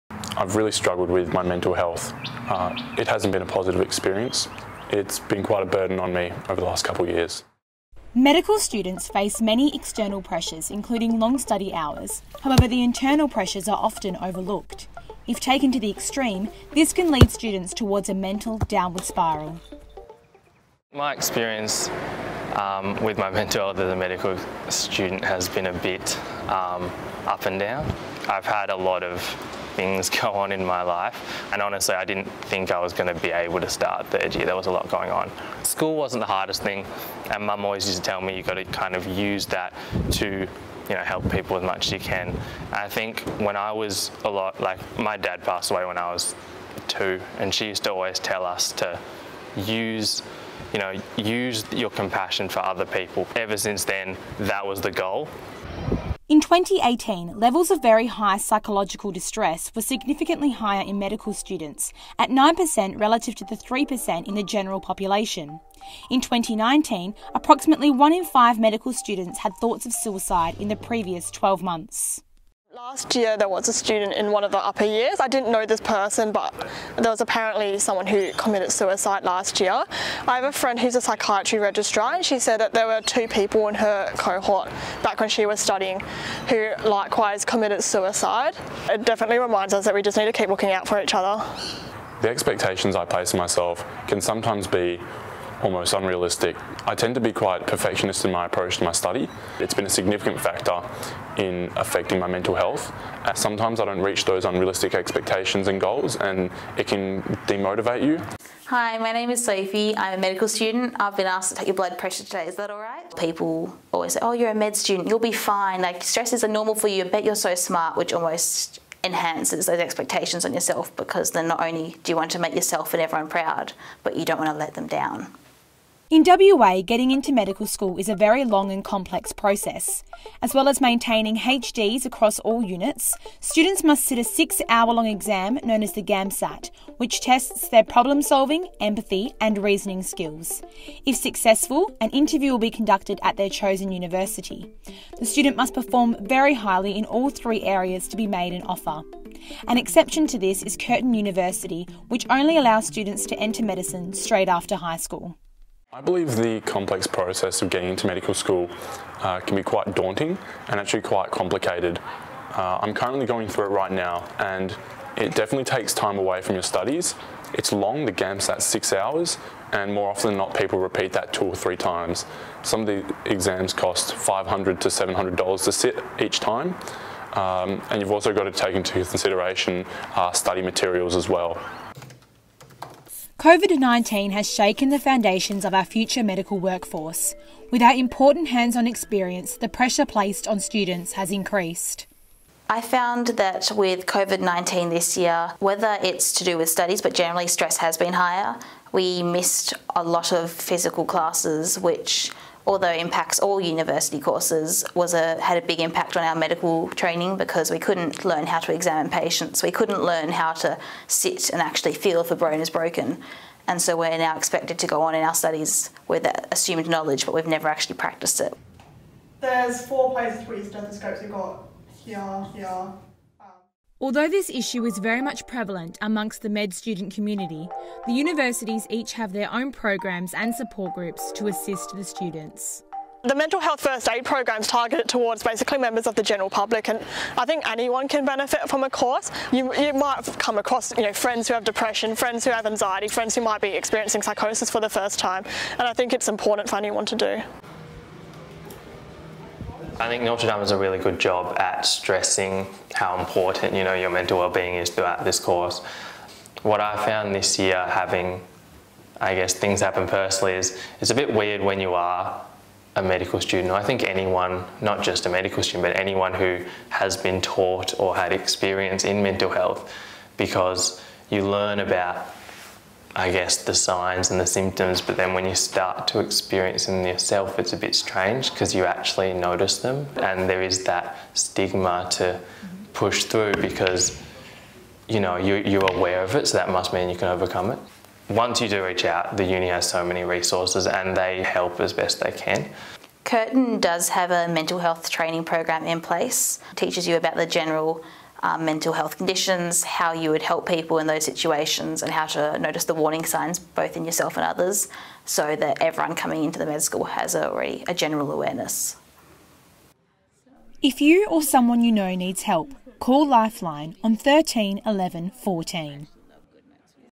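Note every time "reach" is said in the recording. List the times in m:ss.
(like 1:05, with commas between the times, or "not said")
1:44, 4:48.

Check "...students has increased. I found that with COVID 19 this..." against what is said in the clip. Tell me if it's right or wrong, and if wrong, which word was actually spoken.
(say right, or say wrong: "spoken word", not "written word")
right.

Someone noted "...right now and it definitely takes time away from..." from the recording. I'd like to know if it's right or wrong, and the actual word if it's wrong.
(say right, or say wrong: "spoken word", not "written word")
right.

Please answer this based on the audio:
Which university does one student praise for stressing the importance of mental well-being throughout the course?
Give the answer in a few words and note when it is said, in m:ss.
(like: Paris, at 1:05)
Notre Dame, at 4:10.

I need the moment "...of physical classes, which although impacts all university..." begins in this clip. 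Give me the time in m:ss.
3:20.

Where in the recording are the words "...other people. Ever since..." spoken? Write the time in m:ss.
0:52.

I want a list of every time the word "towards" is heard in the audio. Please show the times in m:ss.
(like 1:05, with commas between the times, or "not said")
0:17, 3:55.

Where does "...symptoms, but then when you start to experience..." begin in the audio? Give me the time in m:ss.
4:34.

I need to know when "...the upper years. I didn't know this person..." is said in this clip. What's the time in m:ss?
1:14.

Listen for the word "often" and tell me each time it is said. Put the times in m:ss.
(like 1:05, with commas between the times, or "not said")
0:13, 2:50.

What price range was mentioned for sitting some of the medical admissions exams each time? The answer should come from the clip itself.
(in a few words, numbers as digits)
$500 to $700.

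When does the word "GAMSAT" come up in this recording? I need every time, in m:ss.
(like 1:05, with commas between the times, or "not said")
2:16, 2:48.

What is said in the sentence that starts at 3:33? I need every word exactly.
And so we're now expected to go on in our studies with that assumed knowledge, but we've never actually practiced it.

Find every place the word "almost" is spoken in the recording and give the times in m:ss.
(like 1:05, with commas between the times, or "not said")
1:35, 1:58.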